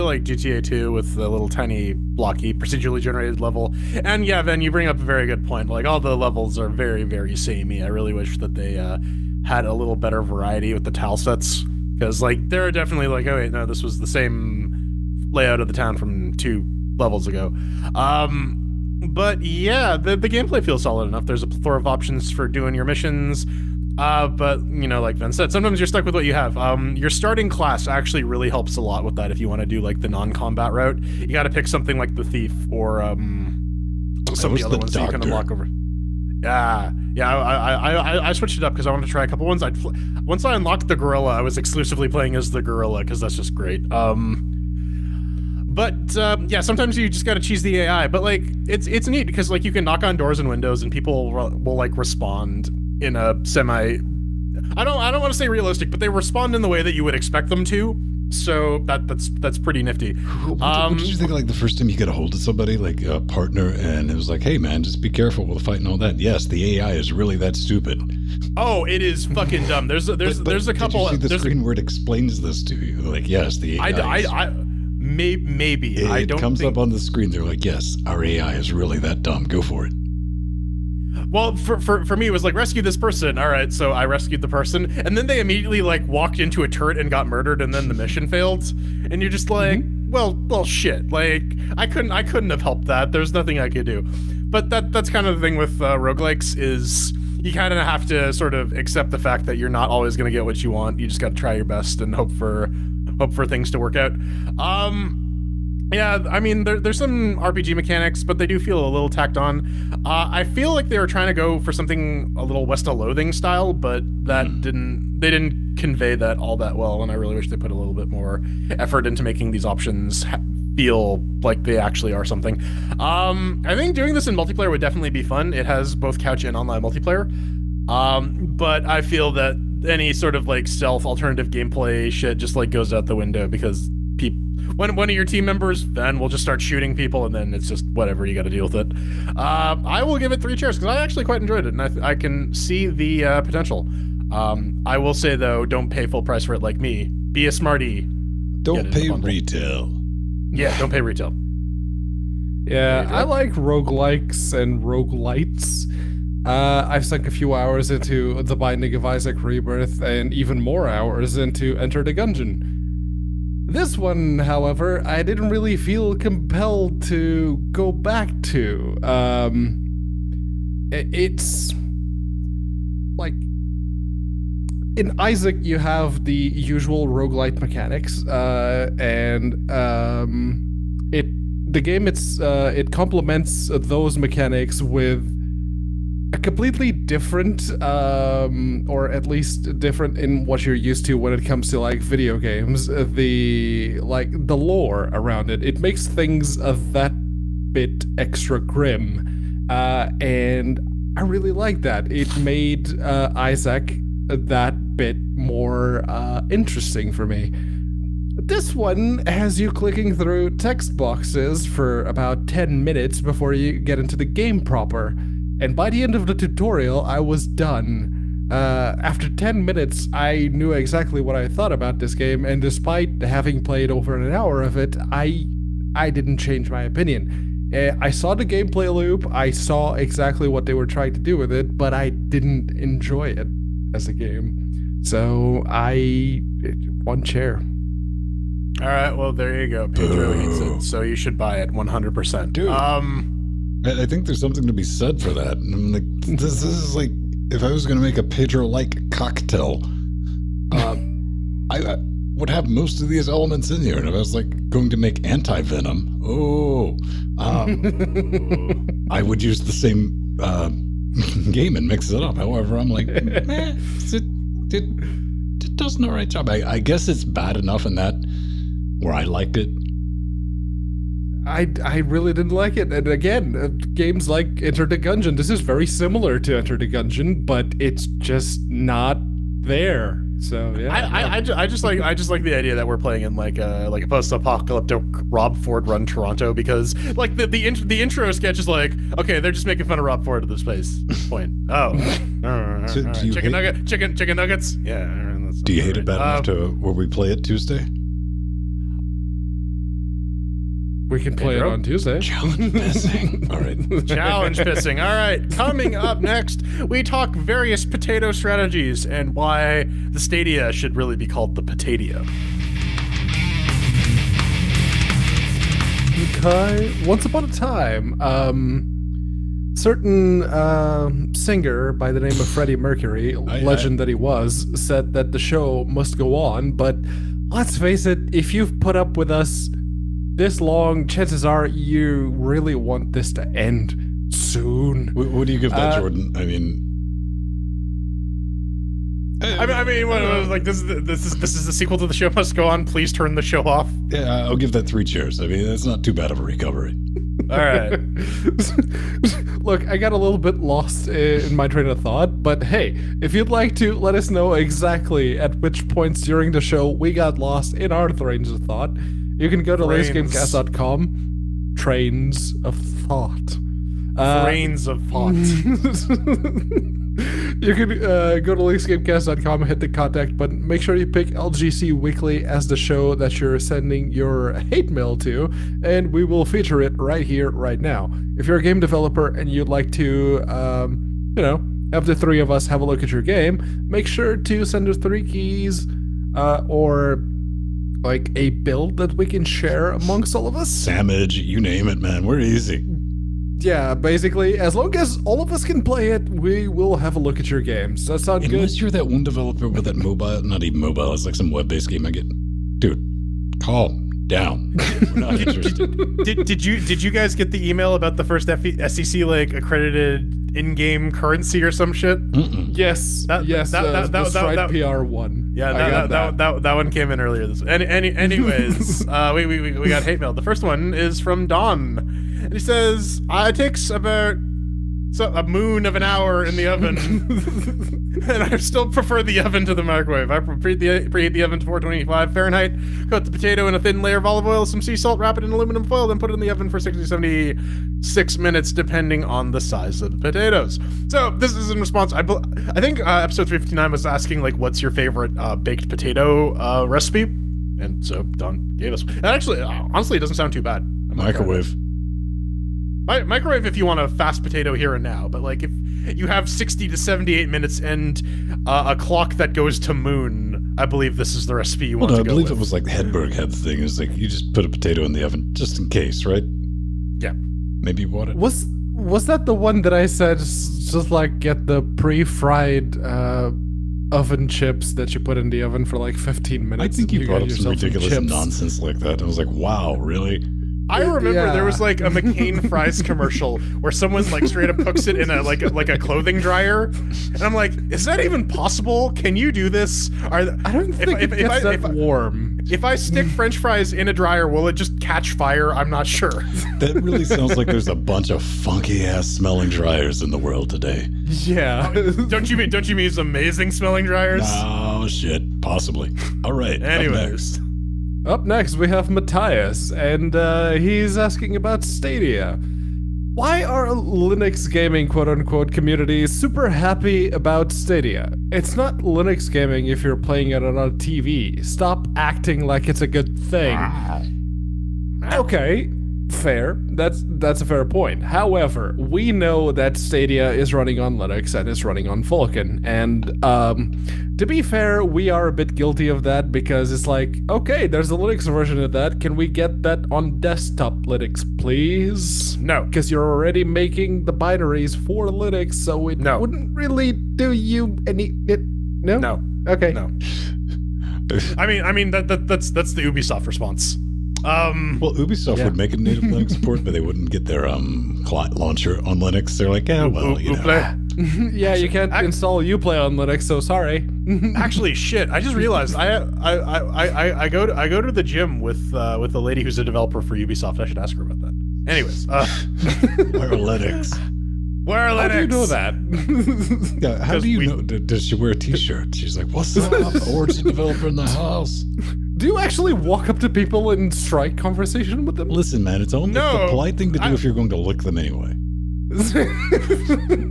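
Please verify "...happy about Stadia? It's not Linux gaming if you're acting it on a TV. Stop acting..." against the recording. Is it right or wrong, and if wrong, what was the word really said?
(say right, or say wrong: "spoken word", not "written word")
wrong: "playing", not "acting".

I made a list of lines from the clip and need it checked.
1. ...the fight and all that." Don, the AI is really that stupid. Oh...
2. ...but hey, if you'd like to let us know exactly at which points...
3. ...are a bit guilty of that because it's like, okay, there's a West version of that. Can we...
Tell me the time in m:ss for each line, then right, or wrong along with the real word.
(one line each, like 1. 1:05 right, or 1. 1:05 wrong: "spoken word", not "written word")
1. 1:05 wrong: "Yes", not "Don"
2. 5:52 right
3. 8:55 wrong: "Linux", not "West".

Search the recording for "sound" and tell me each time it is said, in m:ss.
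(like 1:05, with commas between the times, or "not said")
6:38, 7:30, 8:17.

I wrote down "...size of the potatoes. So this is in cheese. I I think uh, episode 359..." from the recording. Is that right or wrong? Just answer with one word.
wrong.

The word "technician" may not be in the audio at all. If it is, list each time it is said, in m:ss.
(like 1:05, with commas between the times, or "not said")
not said.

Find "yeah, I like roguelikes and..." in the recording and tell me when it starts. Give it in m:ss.
2:32.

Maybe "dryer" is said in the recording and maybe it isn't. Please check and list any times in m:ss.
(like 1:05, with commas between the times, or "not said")
8:06, 8:14, 8:19, 8:24.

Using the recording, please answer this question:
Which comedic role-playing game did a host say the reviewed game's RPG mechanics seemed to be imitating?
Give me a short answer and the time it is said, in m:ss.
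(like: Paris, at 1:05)
West of Loathing, at 1:52.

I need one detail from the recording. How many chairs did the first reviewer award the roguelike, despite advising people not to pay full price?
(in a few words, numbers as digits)
3.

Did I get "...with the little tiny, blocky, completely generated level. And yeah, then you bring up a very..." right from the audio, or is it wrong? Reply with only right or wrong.
wrong.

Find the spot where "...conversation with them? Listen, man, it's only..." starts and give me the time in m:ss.
9:44.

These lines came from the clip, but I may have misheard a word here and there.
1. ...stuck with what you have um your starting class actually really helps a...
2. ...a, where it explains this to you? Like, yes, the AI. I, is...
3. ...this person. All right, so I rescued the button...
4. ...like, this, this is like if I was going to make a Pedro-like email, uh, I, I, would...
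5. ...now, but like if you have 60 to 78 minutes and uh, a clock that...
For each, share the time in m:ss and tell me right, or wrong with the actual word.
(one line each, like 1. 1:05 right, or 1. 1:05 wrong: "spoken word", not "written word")
1. 0:25 right
2. 1:11 right
3. 1:22 wrong: "person", not "button"
4. 4:05 wrong: "cocktail", not "email"
5. 7:35 right.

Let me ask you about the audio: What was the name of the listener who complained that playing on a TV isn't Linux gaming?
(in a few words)
Matthias.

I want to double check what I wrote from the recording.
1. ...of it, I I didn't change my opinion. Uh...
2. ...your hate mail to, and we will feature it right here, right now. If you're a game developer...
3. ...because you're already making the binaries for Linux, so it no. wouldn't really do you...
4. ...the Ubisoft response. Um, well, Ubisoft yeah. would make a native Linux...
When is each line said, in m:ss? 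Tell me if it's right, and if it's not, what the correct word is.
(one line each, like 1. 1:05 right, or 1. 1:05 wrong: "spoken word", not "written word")
1. 3:44 right
2. 6:14 right
3. 9:02 right
4. 9:12 right.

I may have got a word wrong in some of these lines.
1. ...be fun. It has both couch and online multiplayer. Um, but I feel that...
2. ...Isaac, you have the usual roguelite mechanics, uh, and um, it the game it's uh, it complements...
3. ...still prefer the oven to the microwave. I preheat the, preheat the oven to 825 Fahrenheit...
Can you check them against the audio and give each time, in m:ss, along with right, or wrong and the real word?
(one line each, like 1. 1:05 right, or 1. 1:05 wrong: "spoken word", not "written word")
1. 2:05 right
2. 2:55 right
3. 7:08 wrong: "425", not "825".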